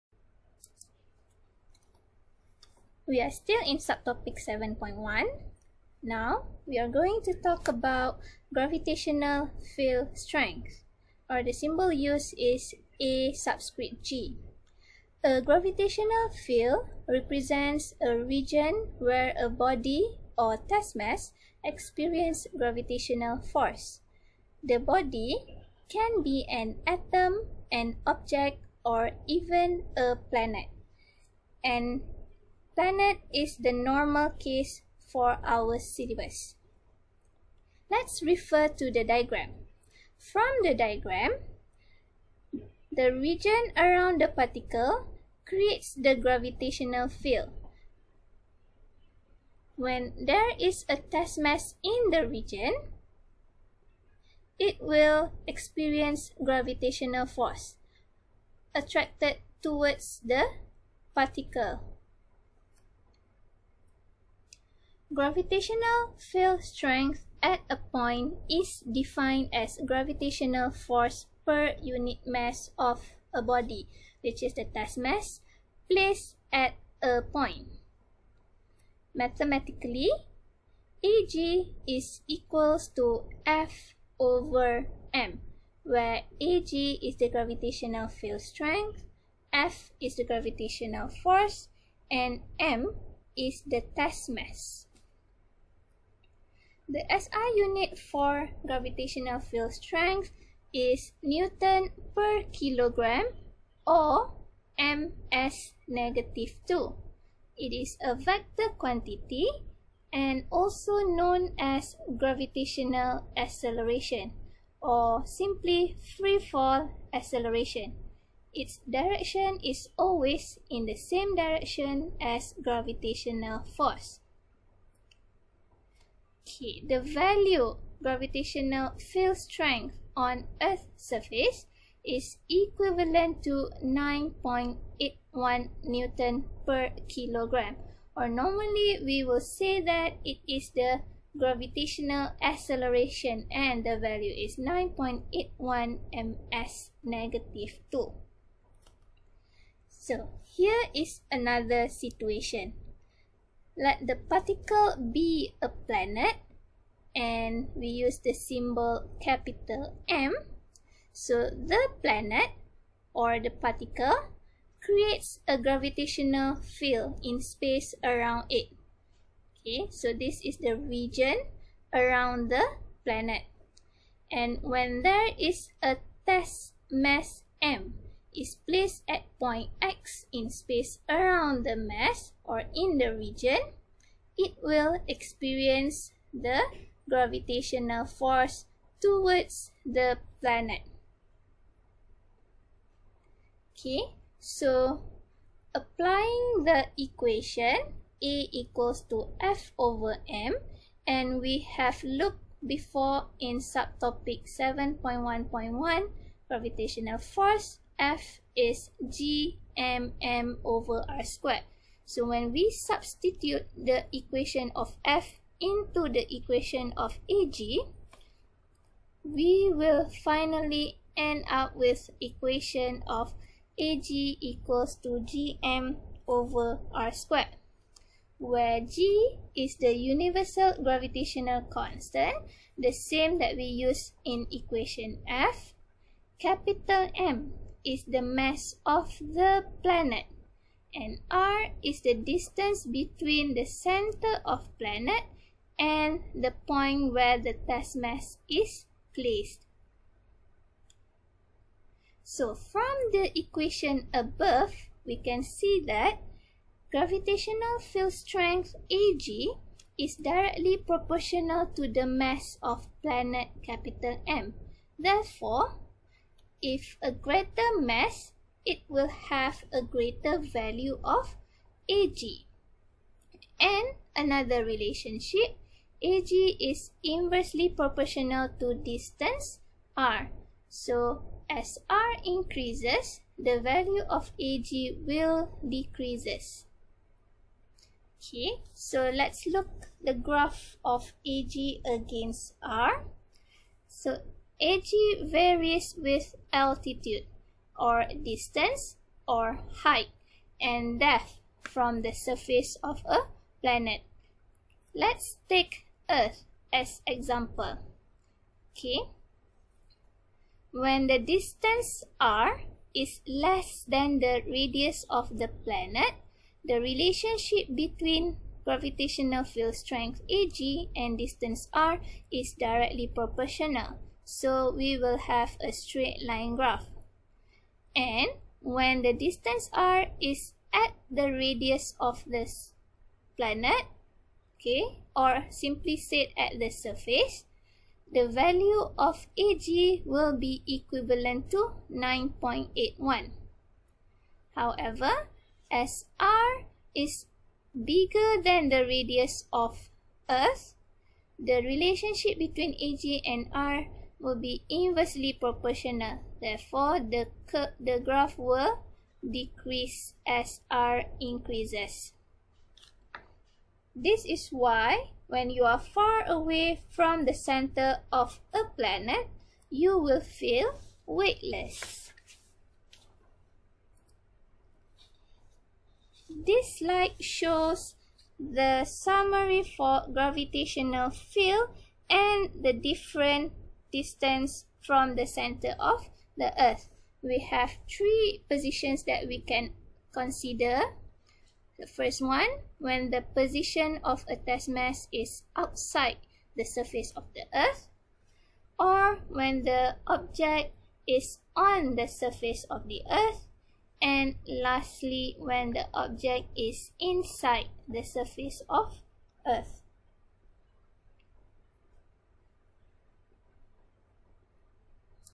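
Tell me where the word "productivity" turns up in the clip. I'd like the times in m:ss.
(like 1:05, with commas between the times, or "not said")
not said.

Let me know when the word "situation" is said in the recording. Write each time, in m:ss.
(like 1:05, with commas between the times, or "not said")
2:31.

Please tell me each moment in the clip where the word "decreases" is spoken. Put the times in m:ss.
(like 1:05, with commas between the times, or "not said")
4:45, 5:59.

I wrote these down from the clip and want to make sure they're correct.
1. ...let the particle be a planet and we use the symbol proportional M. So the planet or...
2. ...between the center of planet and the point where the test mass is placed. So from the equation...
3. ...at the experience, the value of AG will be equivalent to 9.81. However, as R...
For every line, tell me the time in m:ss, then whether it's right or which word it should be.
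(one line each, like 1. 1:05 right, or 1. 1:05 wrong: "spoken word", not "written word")
1. 2:33 wrong: "capital", not "proportional"
2. 4:02 right
3. 5:36 wrong: "surface", not "experience".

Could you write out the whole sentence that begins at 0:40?
From the diagram, the region around the particle creates the gravitational field.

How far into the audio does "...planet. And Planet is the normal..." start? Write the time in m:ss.
0:30.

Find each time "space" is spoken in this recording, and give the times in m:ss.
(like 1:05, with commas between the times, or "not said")
2:47, 3:00.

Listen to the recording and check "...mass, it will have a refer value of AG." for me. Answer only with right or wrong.
wrong.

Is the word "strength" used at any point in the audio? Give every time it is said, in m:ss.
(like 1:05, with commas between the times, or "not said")
0:10, 1:06, 1:28, 1:39, 2:09, 4:18, 5:19.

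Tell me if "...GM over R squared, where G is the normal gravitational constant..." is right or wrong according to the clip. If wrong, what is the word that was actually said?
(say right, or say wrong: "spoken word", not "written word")
wrong: "universal", not "normal".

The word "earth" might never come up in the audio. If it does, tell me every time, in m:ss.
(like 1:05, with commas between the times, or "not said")
2:10, 5:06, 5:50, 6:26, 6:37, 6:43, 6:49.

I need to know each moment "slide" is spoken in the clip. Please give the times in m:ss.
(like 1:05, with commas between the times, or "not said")
6:16.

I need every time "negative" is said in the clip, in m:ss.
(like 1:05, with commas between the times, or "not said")
1:45, 2:27.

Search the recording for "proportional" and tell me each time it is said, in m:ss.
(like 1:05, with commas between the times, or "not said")
4:20, 4:37, 5:23, 5:55.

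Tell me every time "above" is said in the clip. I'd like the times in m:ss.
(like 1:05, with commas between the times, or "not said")
4:14.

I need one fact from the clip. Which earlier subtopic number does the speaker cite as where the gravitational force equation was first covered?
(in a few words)
7.1.1.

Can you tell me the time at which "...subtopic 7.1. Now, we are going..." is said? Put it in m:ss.
0:03.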